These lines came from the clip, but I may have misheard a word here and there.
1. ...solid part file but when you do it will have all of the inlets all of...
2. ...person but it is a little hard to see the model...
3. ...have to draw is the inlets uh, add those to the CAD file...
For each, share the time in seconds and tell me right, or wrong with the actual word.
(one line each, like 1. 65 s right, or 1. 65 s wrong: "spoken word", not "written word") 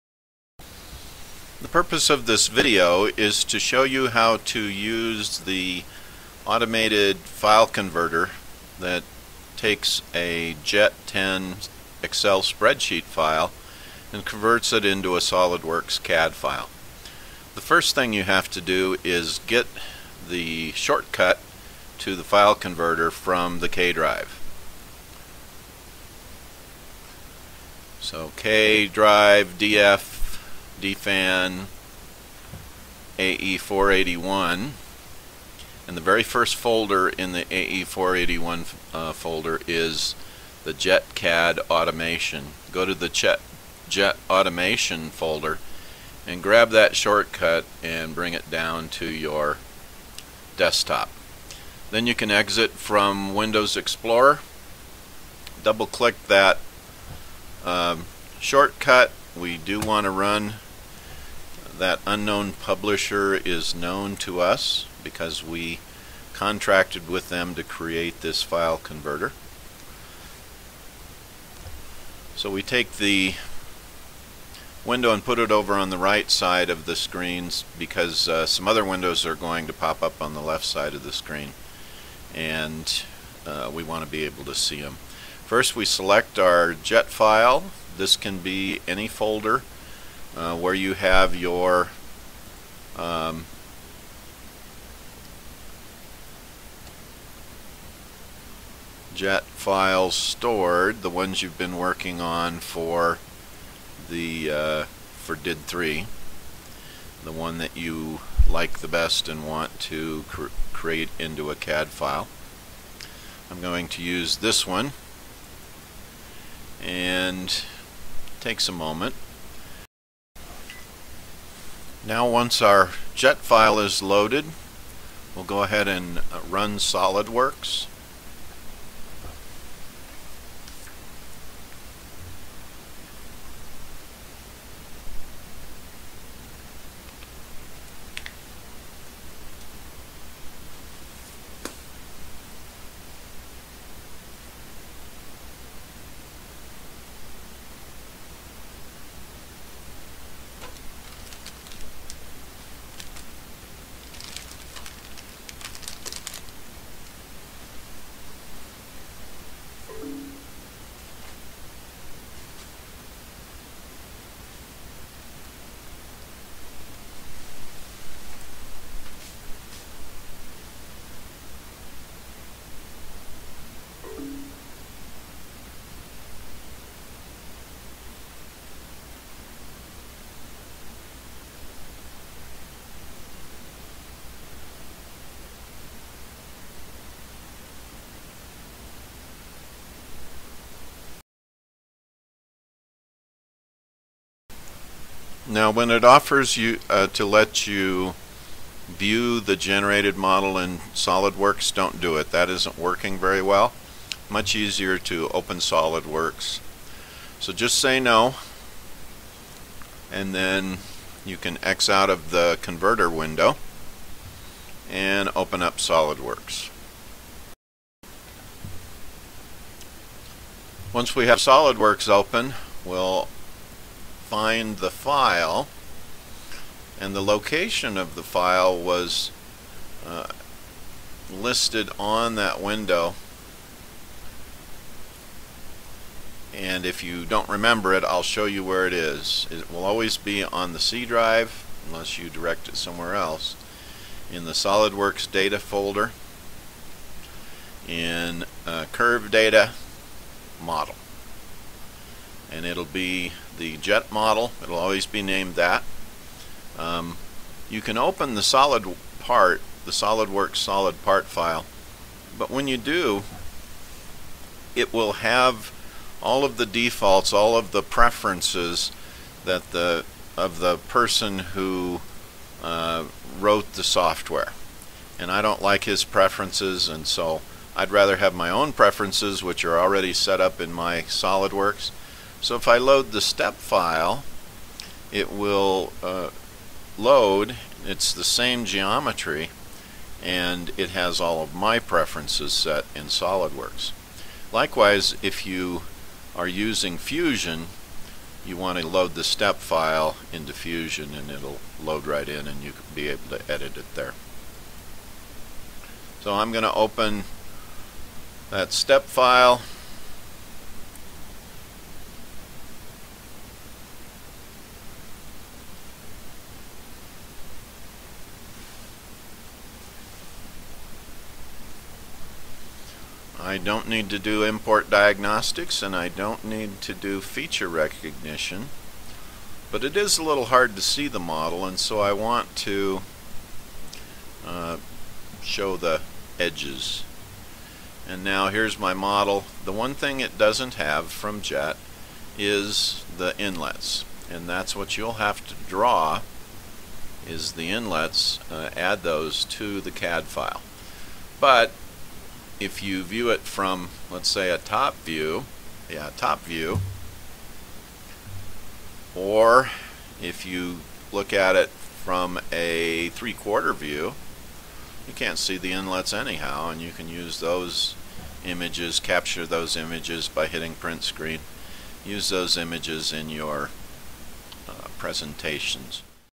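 1. 260 s wrong: "defaults", not "inlets"
2. 327 s wrong: "recognition", not "person"
3. 345 s right.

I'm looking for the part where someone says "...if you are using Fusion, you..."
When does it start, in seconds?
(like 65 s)
295 s.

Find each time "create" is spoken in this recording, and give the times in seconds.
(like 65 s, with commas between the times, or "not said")
67 s, 110 s.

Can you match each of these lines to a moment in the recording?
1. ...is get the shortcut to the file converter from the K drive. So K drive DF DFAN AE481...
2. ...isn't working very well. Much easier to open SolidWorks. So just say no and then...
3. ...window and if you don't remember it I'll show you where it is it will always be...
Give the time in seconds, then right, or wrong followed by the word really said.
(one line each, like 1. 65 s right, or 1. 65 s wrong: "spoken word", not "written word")
1. 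19 s right
2. 202 s right
3. 232 s right.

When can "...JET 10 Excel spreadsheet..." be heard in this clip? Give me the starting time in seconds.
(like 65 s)
10 s.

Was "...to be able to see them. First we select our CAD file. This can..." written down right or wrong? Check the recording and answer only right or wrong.
wrong.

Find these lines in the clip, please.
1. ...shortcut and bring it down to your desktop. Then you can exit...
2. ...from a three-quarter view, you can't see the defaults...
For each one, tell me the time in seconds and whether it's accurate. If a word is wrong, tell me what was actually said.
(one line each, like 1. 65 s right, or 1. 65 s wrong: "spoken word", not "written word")
1. 46 s right
2. 361 s wrong: "inlets", not "defaults".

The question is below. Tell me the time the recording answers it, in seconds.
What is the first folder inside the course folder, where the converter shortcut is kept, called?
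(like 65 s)
40 s.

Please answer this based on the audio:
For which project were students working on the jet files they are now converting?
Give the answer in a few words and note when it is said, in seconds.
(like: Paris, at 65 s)
DID3, at 105 s.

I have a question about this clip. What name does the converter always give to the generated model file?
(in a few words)
jet model.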